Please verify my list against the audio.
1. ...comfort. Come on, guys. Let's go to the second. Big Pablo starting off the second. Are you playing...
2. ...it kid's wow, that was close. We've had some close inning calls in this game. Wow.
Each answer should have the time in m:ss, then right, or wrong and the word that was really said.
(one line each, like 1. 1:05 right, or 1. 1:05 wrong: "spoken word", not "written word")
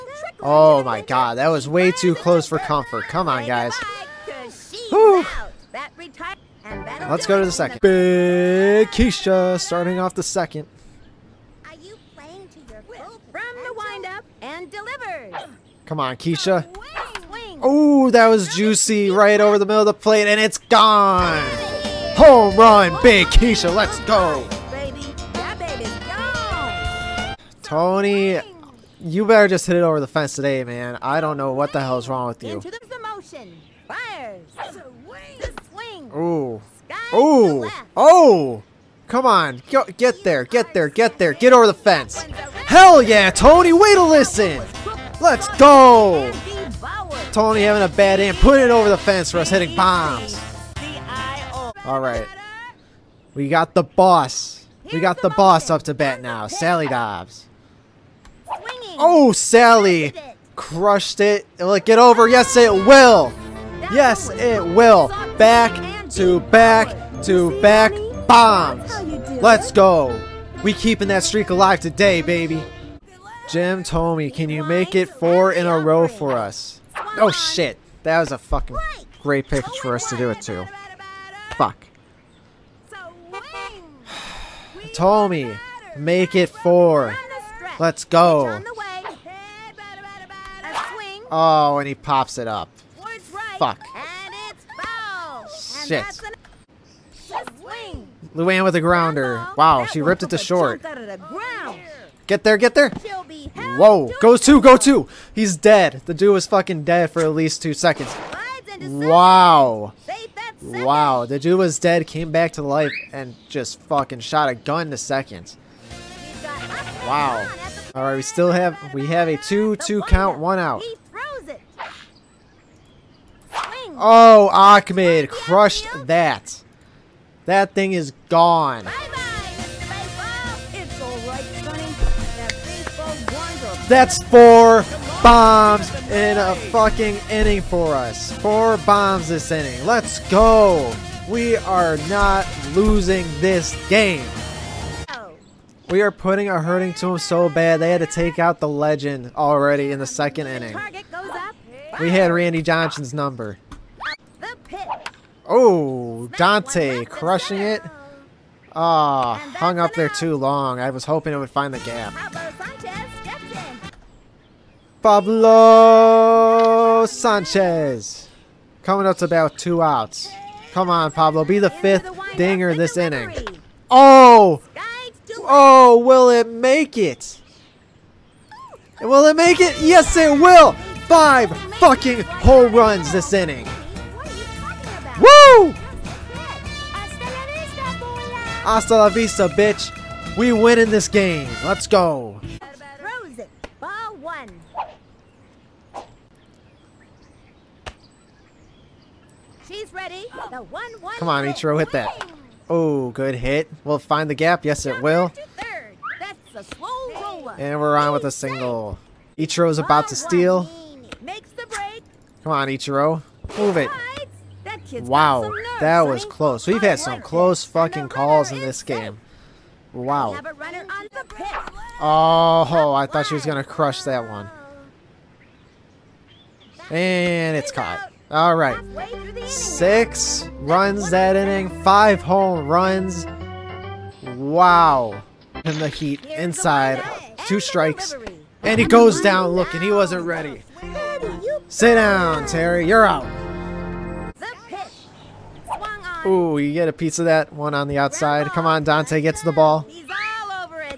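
1. 0:02 wrong: "Keisha", not "Pablo"
2. 3:33 wrong: "fucking", not "inning".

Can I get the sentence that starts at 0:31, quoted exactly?
I don't know what the hell's wrong with you.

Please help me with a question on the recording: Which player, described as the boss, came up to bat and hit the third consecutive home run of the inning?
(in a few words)
Sally Dobbs.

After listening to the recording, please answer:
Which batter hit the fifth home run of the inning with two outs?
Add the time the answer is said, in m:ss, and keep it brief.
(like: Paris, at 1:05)
Pablo Sanchez, at 2:45.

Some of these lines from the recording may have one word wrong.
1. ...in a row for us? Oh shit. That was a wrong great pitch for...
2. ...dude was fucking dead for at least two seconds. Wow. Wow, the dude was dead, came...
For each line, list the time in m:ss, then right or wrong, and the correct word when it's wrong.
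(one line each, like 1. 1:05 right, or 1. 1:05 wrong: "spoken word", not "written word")
1. 1:15 wrong: "fucking", not "wrong"
2. 1:46 right.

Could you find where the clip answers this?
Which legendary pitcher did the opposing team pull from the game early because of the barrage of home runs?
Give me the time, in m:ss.
2:32.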